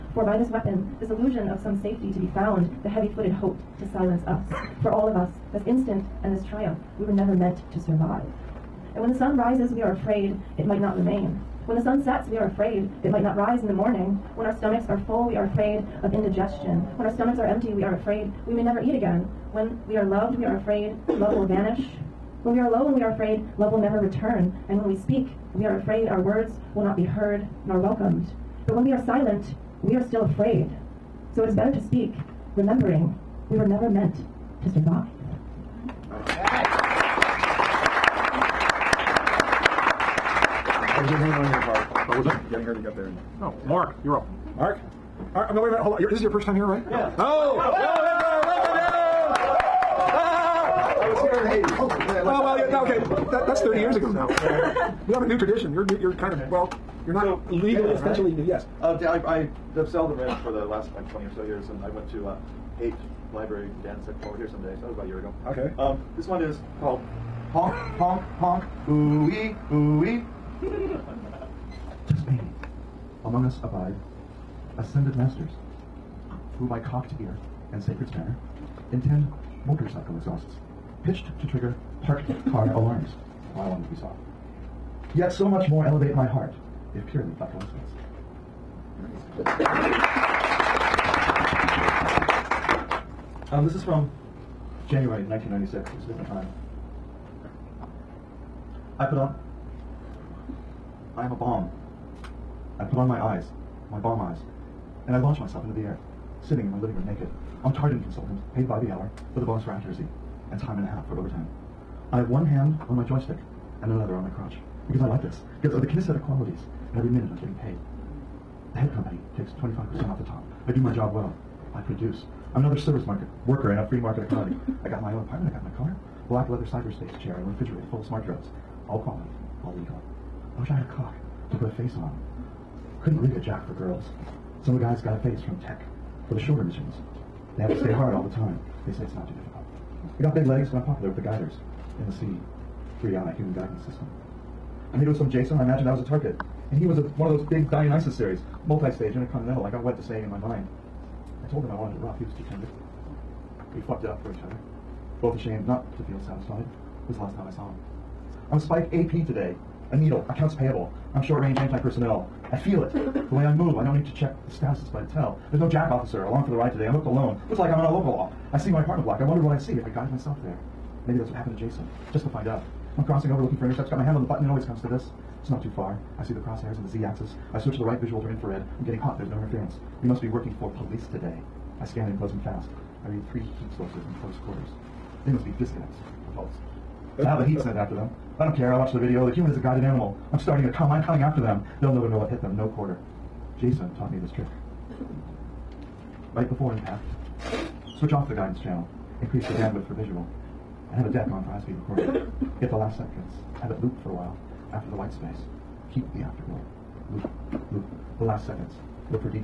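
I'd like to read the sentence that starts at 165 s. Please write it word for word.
There's no jack officer along for the ride today.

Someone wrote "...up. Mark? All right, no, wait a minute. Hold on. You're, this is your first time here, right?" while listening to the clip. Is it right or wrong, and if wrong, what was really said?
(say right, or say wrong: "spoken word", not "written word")
right.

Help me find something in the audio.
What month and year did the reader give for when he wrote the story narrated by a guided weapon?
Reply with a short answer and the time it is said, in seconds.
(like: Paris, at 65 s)
January 1996, at 94 s.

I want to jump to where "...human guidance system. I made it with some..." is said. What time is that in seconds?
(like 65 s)
143 s.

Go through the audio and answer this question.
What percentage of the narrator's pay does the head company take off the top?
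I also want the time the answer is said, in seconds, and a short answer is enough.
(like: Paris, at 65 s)
25%, at 119 s.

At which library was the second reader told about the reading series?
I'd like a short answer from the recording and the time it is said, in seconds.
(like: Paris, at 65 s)
Haight Library, at 62 s.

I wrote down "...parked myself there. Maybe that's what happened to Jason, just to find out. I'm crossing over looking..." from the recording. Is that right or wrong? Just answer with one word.
wrong.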